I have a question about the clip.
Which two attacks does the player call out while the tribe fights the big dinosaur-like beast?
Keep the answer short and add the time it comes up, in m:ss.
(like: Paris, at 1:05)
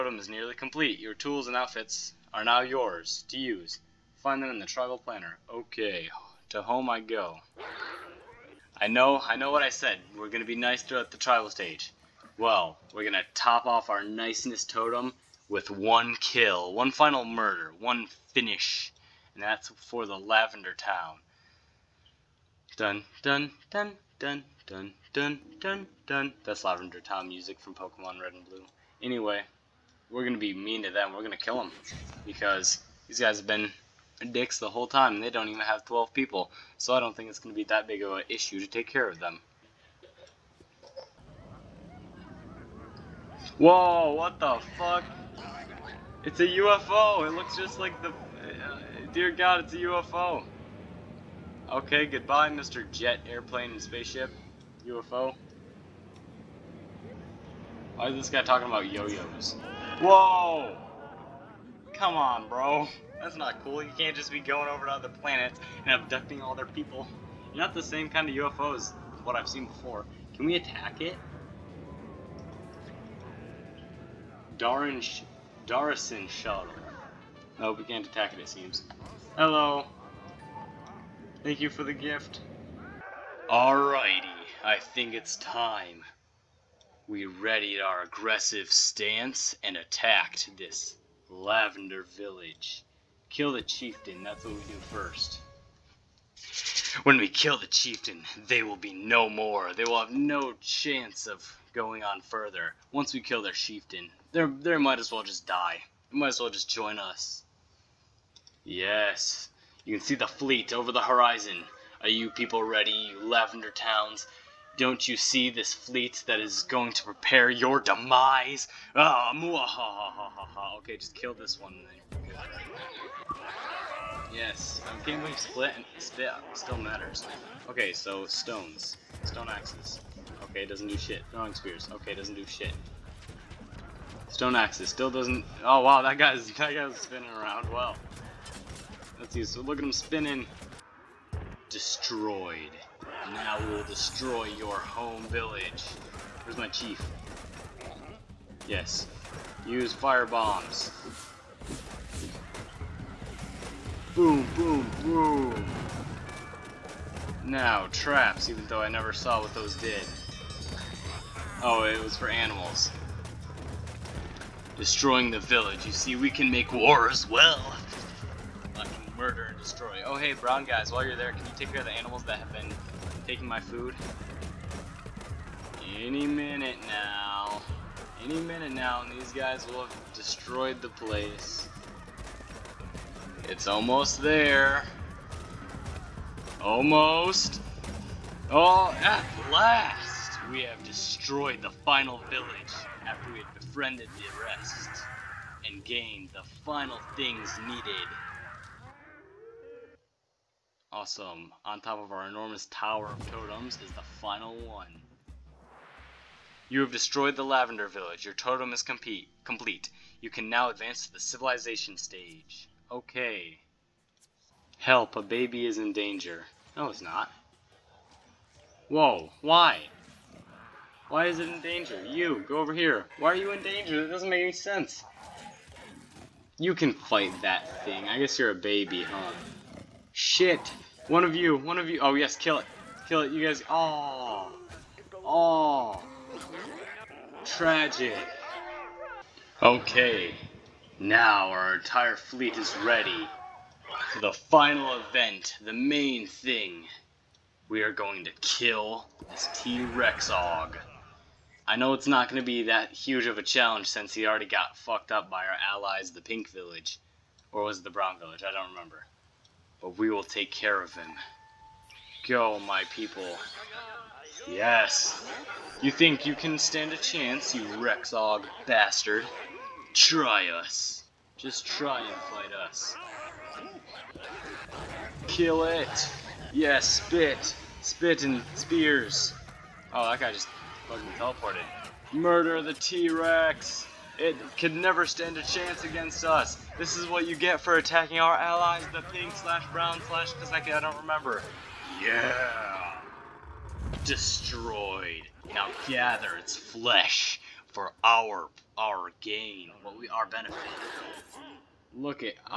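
Spit and spears, at 4:37.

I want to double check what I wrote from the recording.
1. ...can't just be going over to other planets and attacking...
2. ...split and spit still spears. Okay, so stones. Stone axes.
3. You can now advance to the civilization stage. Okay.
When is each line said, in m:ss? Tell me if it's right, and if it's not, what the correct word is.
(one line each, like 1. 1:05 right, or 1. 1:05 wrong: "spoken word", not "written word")
1. 1:03 wrong: "abducting", not "attacking"
2. 2:05 wrong: "matters", not "spears"
3. 3:30 right.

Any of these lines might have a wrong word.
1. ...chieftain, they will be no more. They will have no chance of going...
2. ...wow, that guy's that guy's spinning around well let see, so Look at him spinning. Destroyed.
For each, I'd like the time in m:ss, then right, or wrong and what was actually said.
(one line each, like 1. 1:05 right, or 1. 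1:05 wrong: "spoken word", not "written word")
1. 1:37 right
2. 2:15 right.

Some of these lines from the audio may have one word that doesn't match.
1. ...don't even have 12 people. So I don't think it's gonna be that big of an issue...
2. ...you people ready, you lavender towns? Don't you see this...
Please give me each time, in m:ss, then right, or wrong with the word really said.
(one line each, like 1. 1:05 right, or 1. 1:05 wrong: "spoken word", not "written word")
1. 0:35 right
2. 1:52 right.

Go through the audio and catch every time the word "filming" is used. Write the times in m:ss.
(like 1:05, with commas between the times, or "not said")
not said.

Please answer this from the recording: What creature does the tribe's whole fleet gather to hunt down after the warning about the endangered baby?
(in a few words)
T-Rexog.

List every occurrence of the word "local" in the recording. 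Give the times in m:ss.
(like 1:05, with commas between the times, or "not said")
not said.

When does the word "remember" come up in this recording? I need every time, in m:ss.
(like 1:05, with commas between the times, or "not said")
4:18, 4:50.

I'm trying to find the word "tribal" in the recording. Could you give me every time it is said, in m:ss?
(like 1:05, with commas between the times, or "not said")
0:04, 0:11.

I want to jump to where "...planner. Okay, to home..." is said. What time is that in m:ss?
0:04.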